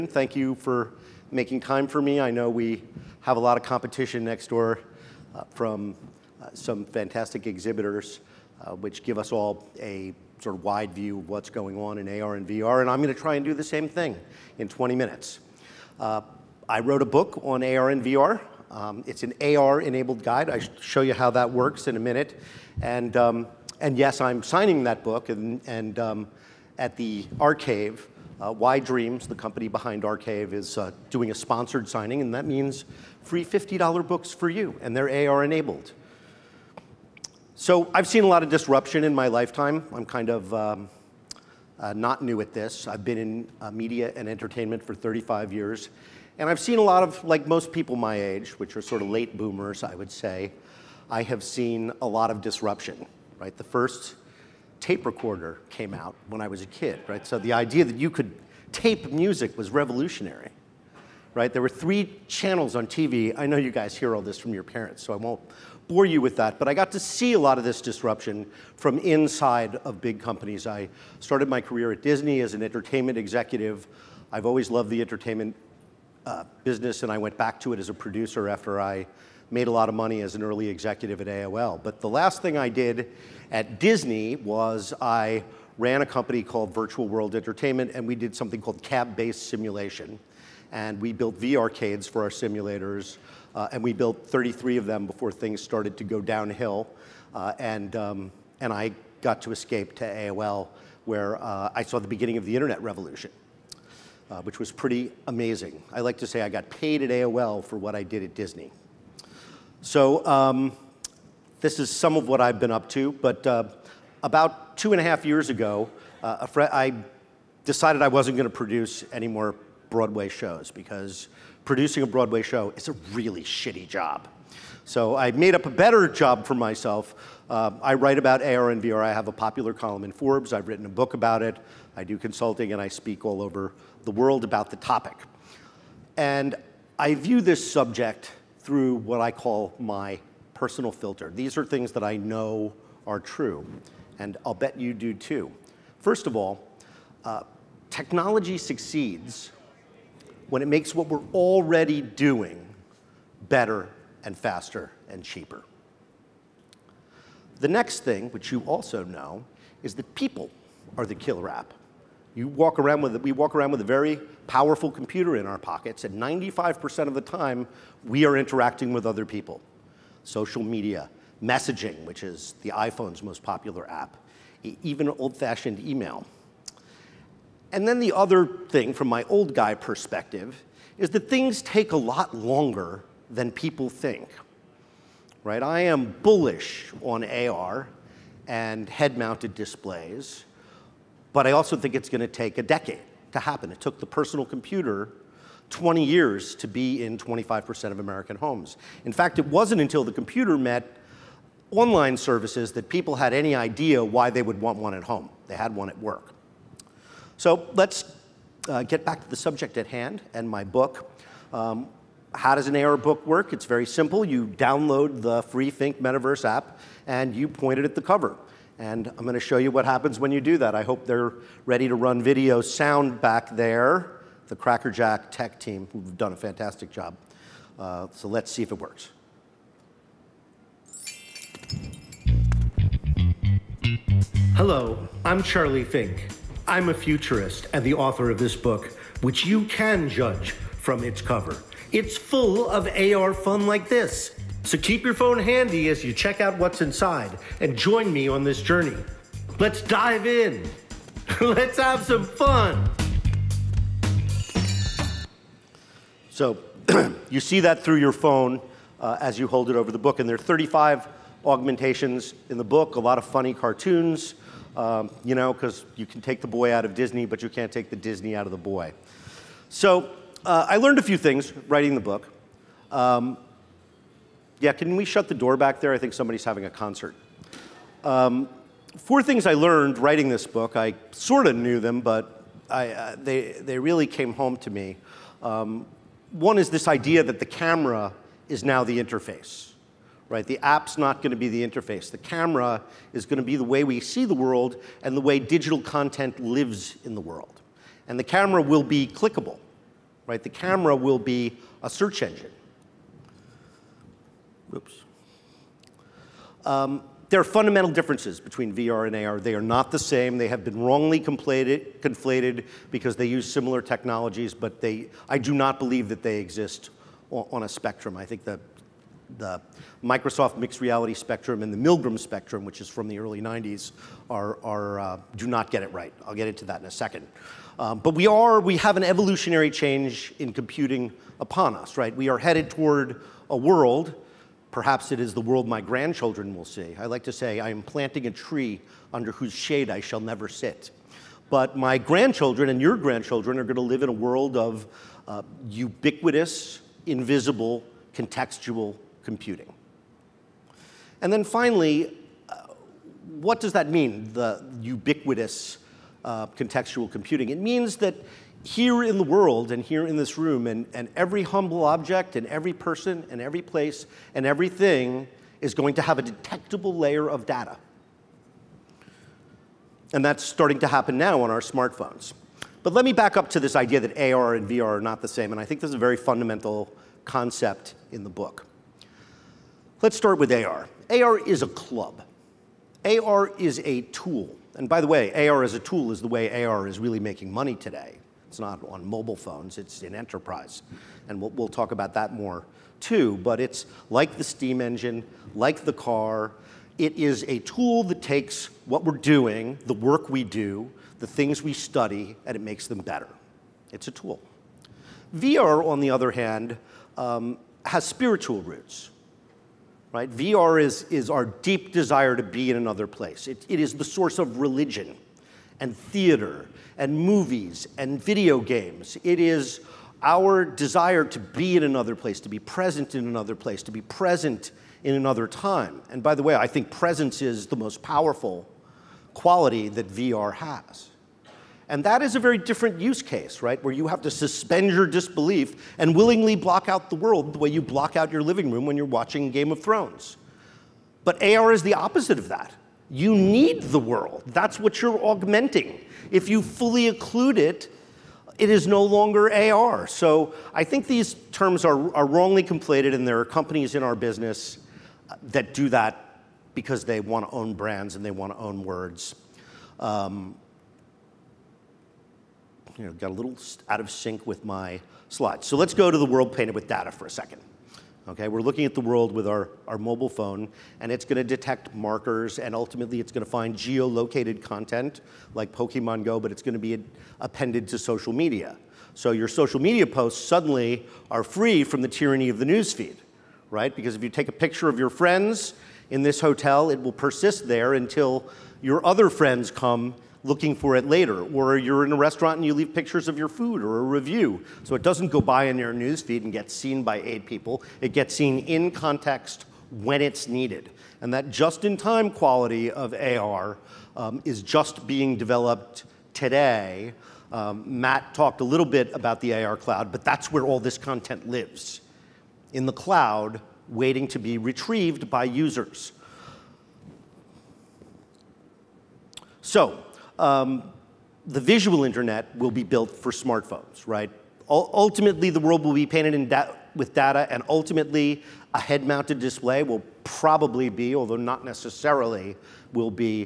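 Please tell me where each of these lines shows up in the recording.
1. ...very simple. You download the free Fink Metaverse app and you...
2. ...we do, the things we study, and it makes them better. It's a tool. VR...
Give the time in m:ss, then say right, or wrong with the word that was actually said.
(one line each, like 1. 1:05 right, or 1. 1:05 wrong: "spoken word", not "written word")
1. 3:33 right
2. 6:40 right.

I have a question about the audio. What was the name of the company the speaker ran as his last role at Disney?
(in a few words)
Virtual World Entertainment.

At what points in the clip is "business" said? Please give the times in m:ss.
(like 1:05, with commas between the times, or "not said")
1:16, 7:34.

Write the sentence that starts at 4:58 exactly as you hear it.
And the camera will be clickable, right?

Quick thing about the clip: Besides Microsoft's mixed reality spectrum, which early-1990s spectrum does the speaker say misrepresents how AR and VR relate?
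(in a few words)
Milgram spectrum.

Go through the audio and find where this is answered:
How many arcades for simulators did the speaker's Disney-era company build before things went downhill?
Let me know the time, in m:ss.
1:34.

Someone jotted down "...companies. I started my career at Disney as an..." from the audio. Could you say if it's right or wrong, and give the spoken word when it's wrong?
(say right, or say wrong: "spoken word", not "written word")
right.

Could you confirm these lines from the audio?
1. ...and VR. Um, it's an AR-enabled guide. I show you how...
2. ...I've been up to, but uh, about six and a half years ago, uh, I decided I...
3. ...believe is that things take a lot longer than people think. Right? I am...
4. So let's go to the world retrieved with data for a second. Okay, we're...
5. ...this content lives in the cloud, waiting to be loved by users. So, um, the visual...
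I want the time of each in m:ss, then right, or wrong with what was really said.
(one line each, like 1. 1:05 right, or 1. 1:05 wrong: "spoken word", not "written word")
1. 0:17 right
2. 1:52 wrong: "two", not "six"
3. 2:59 wrong: "perspective", not "believe"
4. 7:45 wrong: "painted", not "retrieved"
5. 8:30 wrong: "retrieved", not "loved".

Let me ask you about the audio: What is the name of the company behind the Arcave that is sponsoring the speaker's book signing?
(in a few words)
YDreams.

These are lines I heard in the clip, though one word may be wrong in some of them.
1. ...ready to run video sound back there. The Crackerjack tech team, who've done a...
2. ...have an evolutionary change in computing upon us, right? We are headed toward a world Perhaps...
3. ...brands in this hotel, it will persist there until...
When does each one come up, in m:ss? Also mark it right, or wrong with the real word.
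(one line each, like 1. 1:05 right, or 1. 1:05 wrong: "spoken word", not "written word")
1. 3:41 right
2. 5:28 right
3. 8:05 wrong: "friends", not "brands".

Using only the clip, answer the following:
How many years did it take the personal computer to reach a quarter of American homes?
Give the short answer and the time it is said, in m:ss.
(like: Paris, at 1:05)
20, at 3:15.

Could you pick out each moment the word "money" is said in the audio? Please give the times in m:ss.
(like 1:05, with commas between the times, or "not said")
1:19, 6:27.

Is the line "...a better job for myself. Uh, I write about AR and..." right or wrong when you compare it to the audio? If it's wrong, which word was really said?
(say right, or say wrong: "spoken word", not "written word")
right.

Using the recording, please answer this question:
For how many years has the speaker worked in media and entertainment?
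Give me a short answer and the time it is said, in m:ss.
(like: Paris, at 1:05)
35, at 0:44.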